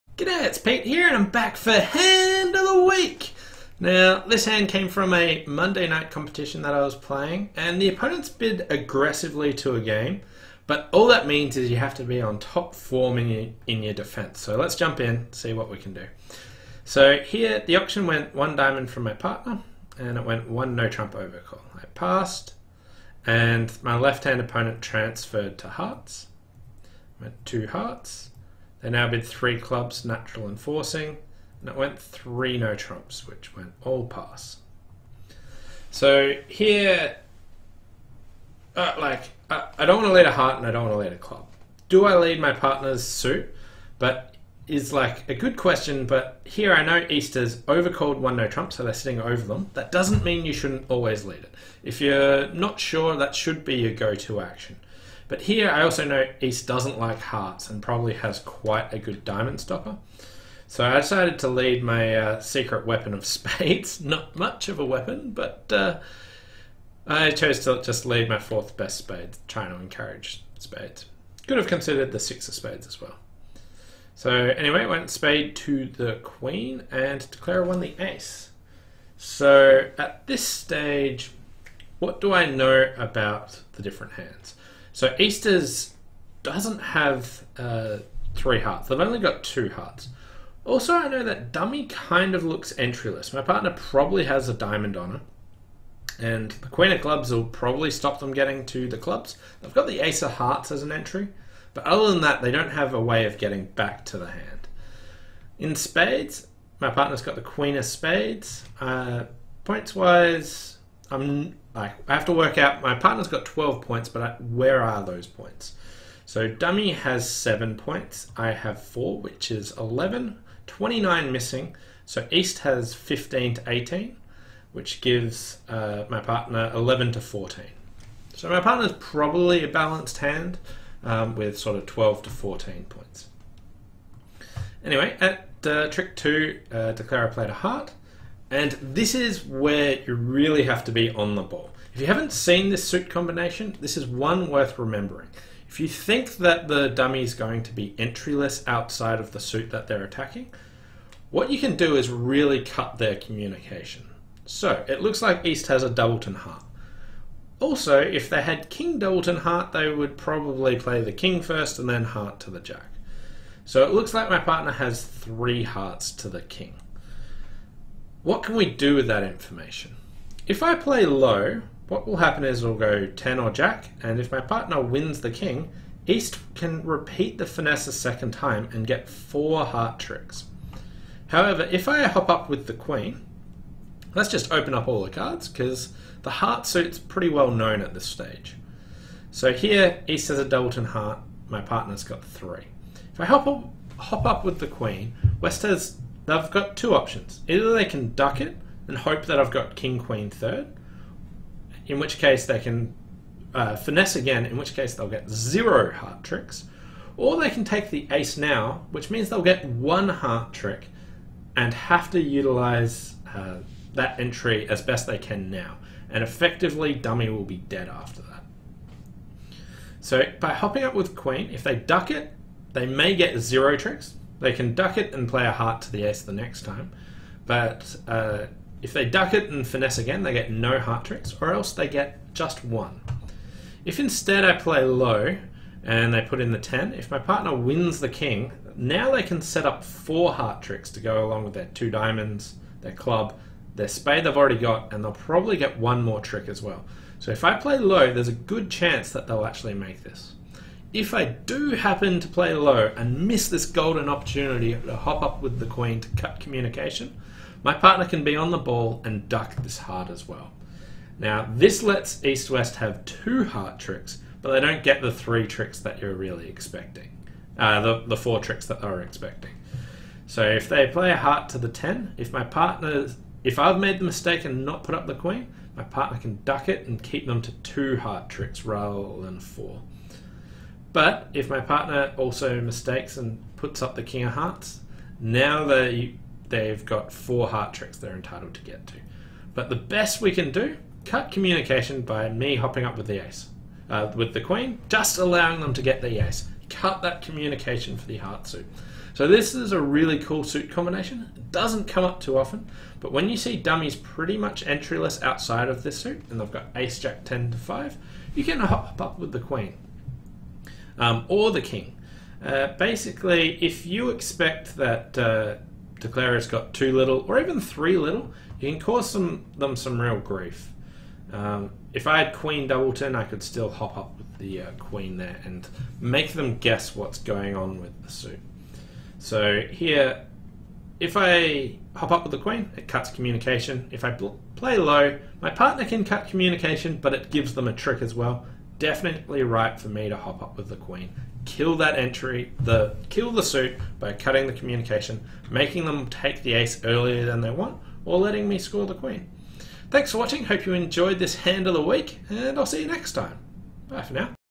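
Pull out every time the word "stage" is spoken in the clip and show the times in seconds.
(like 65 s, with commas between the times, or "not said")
80 s, 188 s.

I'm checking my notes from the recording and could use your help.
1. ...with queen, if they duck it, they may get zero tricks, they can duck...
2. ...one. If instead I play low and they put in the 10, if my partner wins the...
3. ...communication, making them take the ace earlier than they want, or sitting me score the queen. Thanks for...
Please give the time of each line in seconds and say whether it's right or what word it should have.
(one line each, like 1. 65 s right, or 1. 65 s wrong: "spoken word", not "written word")
1. 220 s right
2. 232 s right
3. 344 s wrong: "letting", not "sitting".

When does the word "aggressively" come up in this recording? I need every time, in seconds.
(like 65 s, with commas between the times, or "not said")
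8 s.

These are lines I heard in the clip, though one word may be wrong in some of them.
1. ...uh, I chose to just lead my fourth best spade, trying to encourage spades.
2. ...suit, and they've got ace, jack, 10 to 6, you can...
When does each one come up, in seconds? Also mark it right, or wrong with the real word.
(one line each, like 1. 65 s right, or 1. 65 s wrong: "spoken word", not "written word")
1. 65 s right
2. 305 s wrong: "5", not "6".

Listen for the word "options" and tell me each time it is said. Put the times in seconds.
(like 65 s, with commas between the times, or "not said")
196 s.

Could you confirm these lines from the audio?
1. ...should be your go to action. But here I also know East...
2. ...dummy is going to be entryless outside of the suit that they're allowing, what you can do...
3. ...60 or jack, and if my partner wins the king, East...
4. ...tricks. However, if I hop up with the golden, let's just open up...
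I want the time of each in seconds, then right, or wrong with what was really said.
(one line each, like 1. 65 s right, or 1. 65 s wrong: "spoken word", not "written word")
1. 53 s right
2. 146 s wrong: "attacking", not "allowing"
3. 173 s wrong: "10", not "60"
4. 179 s wrong: "queen", not "golden".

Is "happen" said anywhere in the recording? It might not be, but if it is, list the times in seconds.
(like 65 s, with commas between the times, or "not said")
172 s, 251 s.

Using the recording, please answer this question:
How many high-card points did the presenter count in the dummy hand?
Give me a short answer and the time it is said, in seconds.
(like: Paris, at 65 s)
7, at 117 s.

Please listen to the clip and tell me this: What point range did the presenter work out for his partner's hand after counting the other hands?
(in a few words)
11 to 14.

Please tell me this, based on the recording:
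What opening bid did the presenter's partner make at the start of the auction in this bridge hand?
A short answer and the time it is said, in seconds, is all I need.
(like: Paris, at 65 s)
One diamond, at 18 s.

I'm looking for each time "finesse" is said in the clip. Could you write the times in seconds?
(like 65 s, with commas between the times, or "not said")
177 s, 203 s, 229 s.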